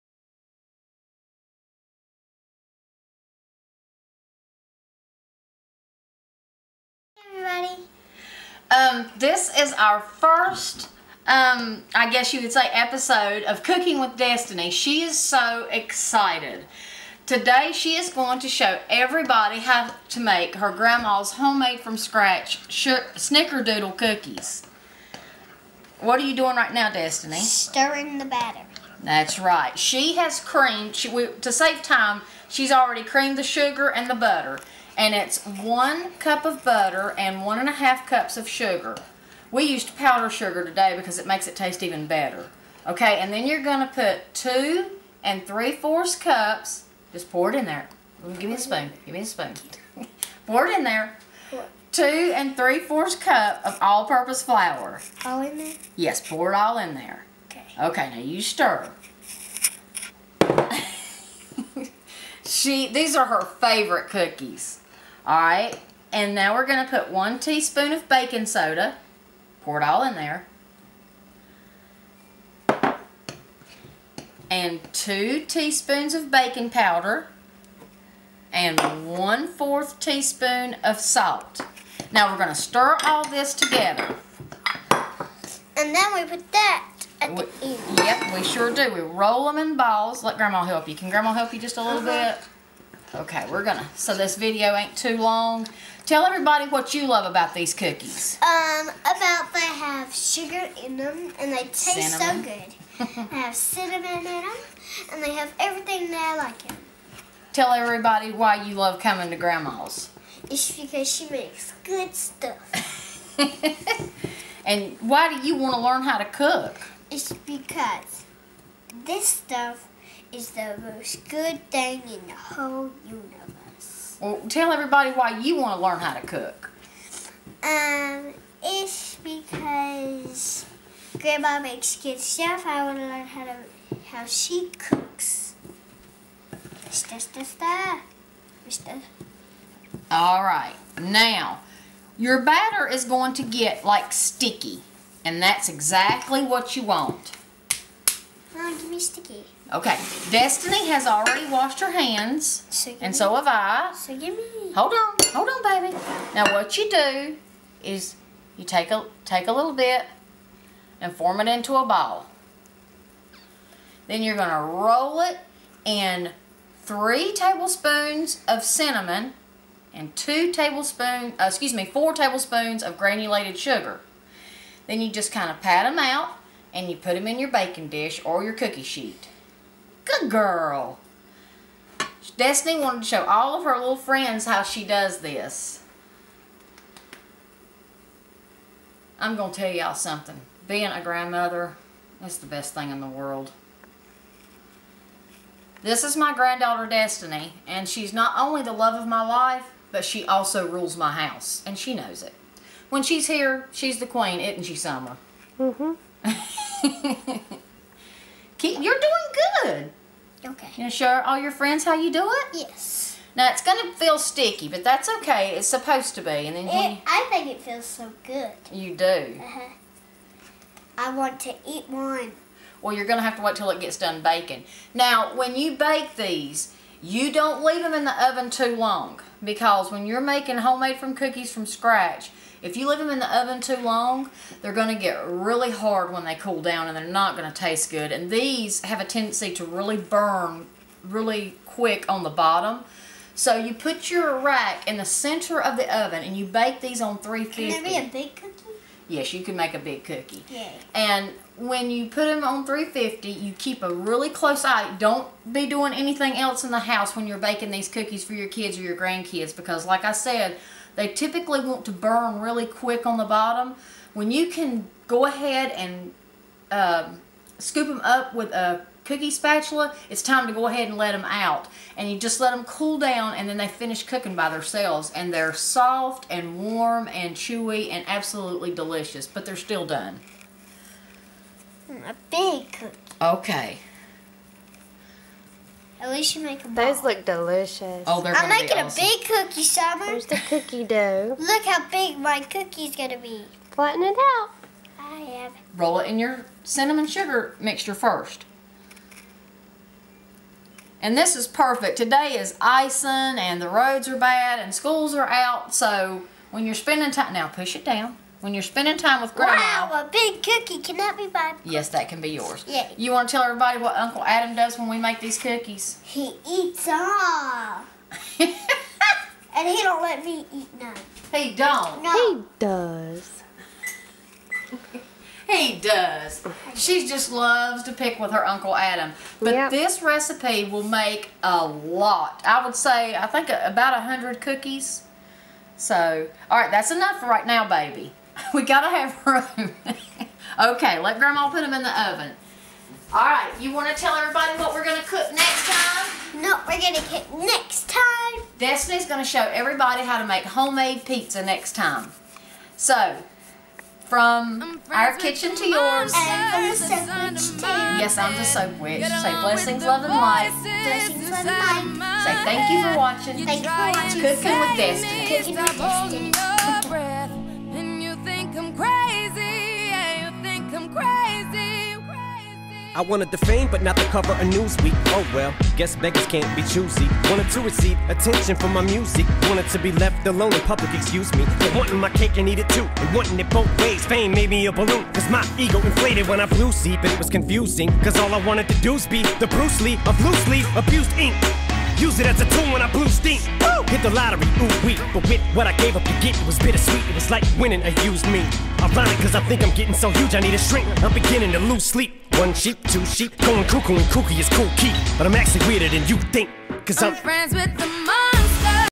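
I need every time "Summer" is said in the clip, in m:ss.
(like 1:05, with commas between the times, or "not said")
3:24, 4:49.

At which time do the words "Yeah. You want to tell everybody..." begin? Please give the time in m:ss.
5:12.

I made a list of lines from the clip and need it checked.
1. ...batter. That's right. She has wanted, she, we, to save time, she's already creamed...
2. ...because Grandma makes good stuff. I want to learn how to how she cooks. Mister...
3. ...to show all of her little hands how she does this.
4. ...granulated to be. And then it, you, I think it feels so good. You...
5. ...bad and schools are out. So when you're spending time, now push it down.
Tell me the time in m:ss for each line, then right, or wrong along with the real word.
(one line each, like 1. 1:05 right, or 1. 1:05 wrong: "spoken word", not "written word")
1. 0:28 wrong: "creamed", not "wanted"
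2. 2:09 right
3. 3:03 wrong: "friends", not "hands"
4. 3:35 wrong: "supposed", not "granulated"
5. 5:04 right.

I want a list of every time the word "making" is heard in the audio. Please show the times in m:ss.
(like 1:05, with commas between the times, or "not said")
3:50, 4:48.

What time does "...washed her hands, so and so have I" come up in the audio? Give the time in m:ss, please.
2:31.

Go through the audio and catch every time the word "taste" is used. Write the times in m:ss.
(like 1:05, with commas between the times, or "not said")
0:41, 1:41, 3:57.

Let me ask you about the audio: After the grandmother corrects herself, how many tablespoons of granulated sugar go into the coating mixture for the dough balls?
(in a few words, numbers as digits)
4 tablespoons.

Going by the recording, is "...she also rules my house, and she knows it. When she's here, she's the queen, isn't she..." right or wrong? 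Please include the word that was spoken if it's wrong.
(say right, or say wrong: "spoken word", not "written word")
right.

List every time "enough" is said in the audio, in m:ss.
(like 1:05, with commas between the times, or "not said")
5:36.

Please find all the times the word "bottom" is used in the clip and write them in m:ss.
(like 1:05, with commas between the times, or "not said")
4:02, 4:23.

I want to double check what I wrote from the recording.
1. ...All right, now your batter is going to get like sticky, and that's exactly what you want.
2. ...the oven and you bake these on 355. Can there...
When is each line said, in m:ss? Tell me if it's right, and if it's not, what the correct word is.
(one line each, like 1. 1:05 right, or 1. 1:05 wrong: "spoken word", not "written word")
1. 2:20 right
2. 4:05 wrong: "350", not "355".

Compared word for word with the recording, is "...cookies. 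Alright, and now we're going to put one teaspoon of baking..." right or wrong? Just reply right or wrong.
right.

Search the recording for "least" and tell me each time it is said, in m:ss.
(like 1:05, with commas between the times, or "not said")
4:46.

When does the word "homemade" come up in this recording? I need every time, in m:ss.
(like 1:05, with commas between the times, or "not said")
0:21, 3:50, 5:50.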